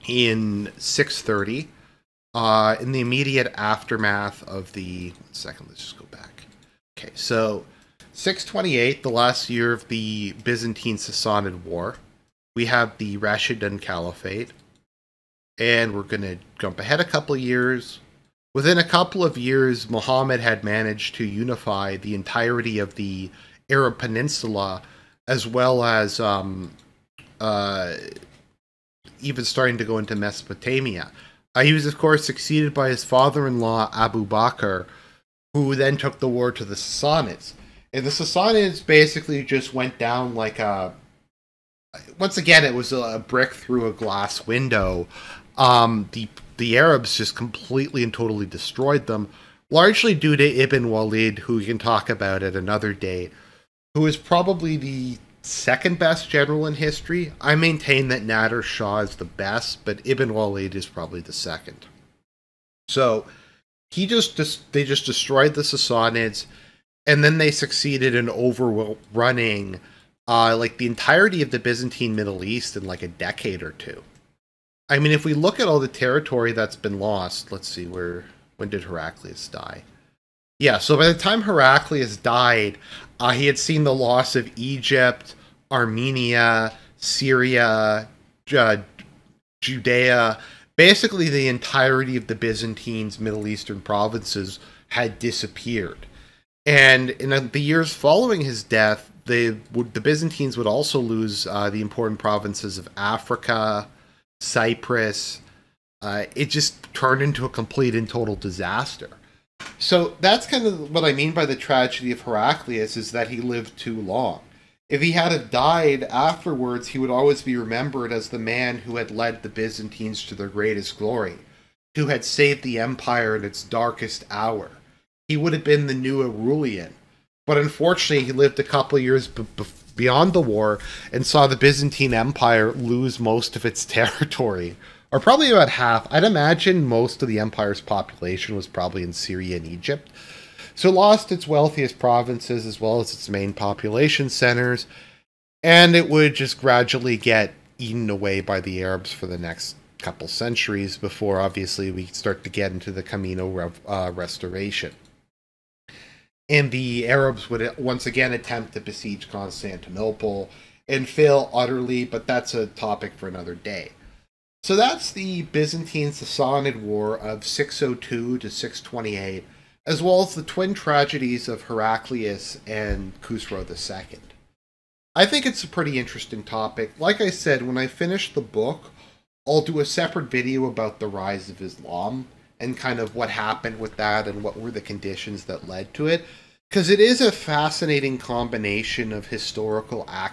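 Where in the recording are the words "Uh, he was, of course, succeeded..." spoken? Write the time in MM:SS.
00:31.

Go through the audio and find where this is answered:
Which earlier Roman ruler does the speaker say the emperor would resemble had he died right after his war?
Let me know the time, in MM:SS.
02:06.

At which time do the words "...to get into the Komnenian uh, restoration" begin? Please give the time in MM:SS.
02:32.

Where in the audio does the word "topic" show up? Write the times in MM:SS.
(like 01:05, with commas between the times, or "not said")
02:42, 02:56.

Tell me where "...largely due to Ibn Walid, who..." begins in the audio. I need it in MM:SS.
00:49.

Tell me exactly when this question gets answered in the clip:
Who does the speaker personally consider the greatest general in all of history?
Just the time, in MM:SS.
00:58.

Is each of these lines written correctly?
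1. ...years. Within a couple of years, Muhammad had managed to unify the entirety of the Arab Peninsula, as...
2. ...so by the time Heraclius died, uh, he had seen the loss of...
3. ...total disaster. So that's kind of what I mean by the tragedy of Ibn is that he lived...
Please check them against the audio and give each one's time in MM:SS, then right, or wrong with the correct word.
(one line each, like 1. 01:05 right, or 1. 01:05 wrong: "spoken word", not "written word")
1. 00:17 right
2. 01:20 right
3. 01:48 wrong: "Heraclius", not "Ibn".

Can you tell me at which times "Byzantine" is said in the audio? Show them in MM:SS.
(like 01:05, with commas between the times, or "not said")
00:10, 01:11, 01:32, 01:40, 01:59, 02:11, 02:45.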